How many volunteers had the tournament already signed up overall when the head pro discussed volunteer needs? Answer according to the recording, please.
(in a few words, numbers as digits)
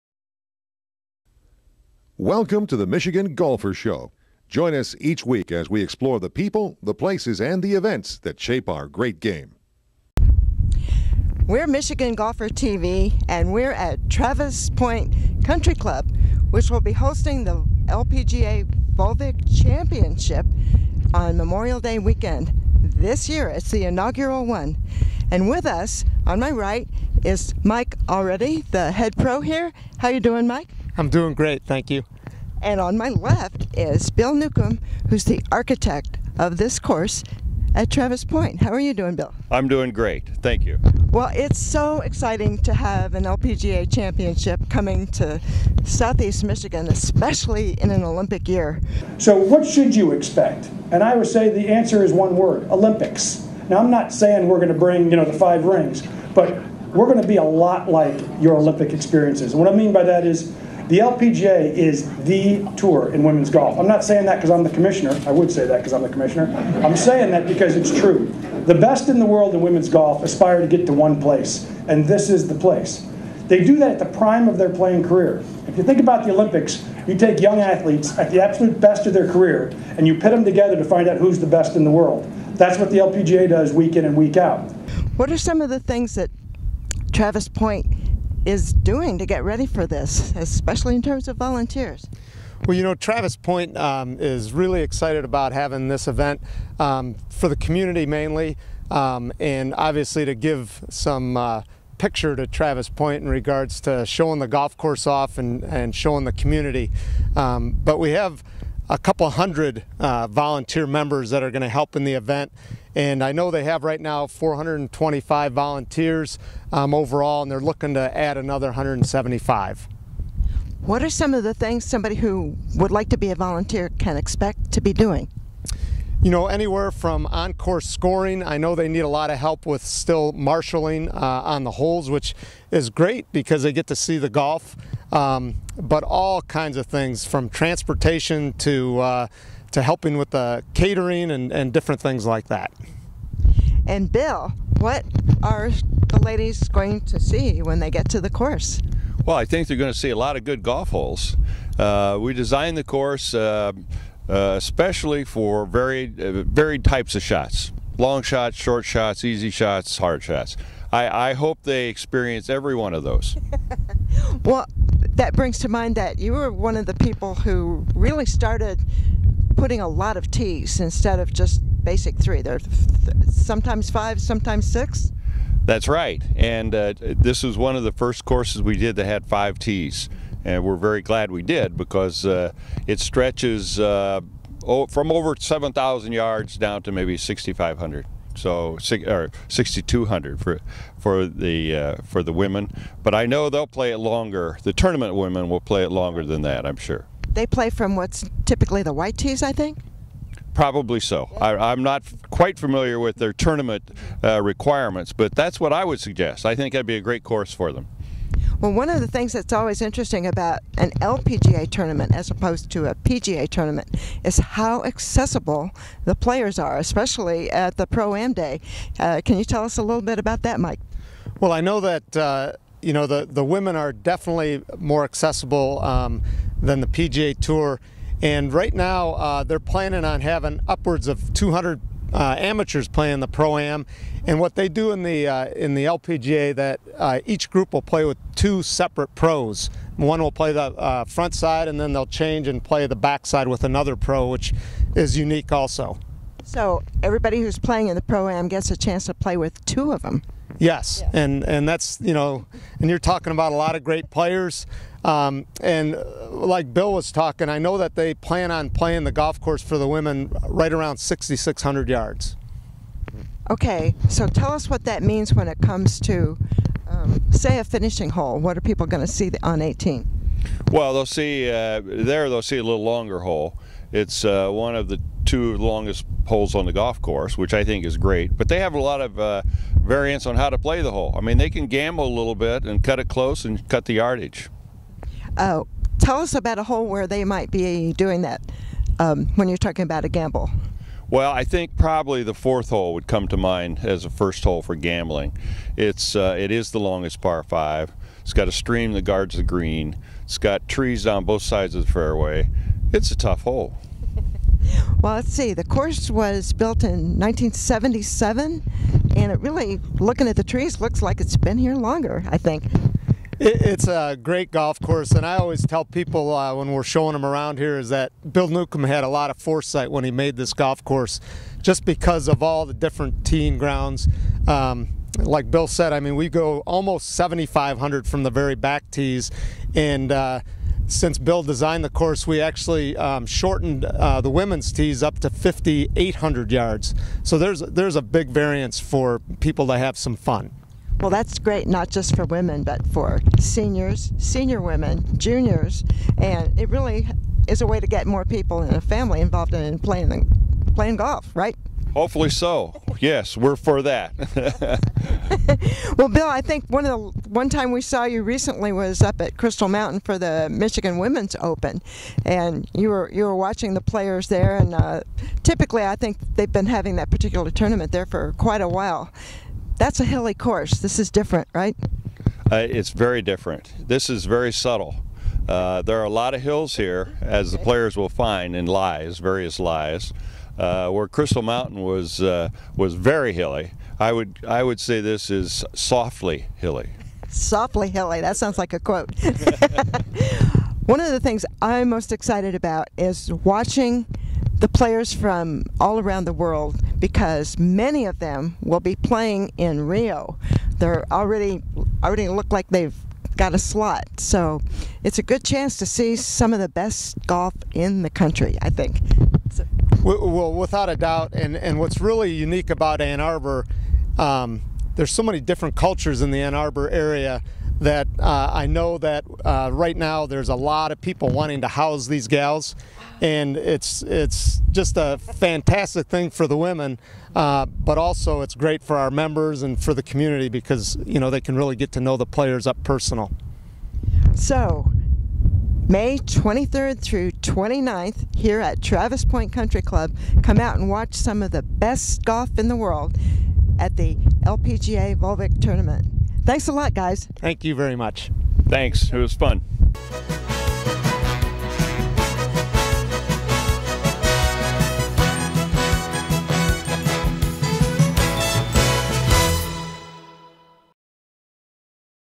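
425.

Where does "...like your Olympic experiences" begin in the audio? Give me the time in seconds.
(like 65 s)
57 s.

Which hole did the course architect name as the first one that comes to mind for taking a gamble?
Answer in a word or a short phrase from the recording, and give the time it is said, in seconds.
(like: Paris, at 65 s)
4th hole, at 292 s.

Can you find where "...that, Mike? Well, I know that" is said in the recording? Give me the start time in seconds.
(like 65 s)
220 s.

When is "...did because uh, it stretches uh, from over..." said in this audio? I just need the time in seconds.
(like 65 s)
181 s.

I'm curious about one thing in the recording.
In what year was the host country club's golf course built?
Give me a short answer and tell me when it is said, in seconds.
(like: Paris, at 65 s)
1977, at 307 s.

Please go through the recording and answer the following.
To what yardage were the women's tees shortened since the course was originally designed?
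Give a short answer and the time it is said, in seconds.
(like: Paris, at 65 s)
5,800 yards, at 335 s.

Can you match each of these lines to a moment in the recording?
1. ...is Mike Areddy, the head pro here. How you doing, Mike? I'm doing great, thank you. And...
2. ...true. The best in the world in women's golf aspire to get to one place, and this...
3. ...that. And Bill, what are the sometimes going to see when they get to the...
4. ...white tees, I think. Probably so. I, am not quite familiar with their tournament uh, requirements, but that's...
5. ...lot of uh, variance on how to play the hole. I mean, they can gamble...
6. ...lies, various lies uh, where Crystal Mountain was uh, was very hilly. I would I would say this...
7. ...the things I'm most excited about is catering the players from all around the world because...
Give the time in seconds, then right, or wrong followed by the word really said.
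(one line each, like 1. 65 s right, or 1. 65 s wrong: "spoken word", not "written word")
1. 27 s right
2. 67 s right
3. 142 s wrong: "ladies", not "sometimes"
4. 198 s right
5. 278 s right
6. 378 s right
7. 391 s wrong: "watching", not "catering".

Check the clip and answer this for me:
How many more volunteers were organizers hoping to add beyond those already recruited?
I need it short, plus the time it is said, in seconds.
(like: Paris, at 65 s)
175, at 118 s.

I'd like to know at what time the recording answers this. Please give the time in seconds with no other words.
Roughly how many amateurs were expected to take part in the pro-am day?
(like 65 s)
230 s.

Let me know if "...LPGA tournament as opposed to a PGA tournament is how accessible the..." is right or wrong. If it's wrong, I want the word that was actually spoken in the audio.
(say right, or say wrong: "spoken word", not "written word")
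right.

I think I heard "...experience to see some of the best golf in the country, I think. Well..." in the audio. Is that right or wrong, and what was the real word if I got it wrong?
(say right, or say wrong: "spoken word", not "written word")
wrong: "chance", not "experience".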